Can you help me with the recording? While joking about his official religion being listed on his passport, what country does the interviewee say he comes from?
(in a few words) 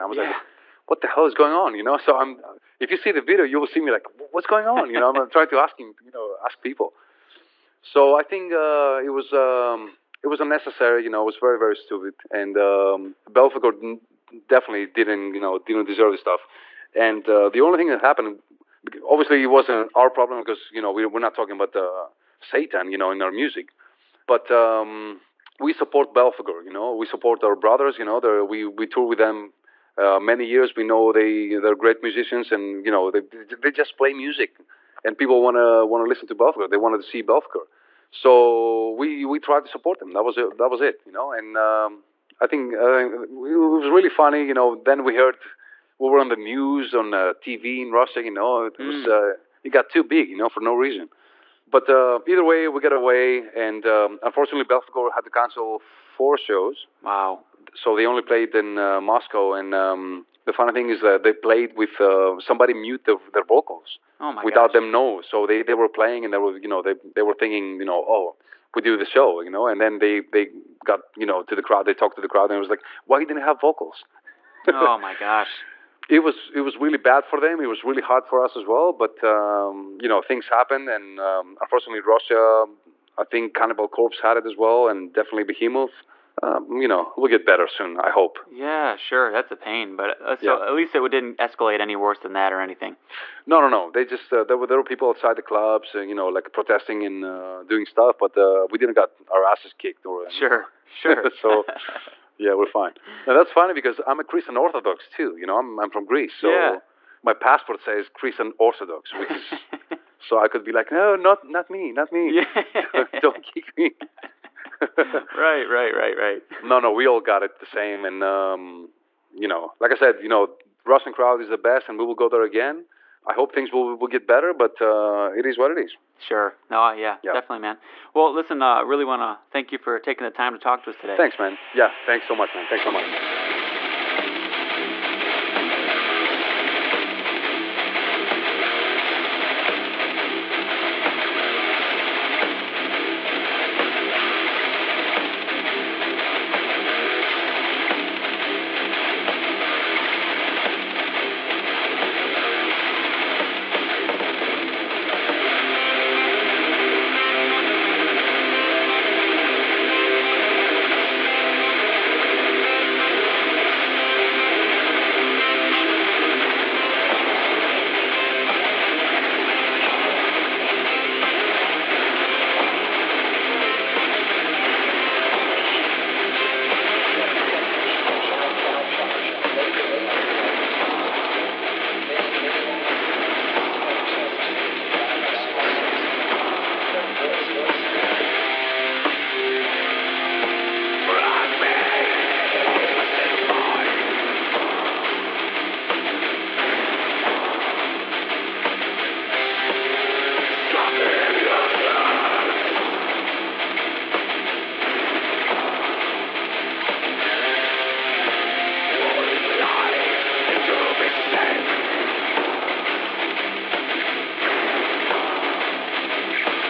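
Greece.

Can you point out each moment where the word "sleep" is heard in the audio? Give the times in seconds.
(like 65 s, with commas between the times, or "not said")
not said.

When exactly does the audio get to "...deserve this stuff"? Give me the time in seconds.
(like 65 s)
15 s.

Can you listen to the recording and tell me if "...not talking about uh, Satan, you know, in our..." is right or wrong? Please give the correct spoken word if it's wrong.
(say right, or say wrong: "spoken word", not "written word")
right.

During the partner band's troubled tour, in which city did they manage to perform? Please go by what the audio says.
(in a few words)
Moscow.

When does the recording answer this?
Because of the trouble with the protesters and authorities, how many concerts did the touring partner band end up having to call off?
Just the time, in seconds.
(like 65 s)
55 s.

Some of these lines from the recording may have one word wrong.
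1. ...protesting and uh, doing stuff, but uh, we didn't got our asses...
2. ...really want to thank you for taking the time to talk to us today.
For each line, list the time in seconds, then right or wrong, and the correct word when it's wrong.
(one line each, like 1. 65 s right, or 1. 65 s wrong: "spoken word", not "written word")
1. 96 s right
2. 128 s right.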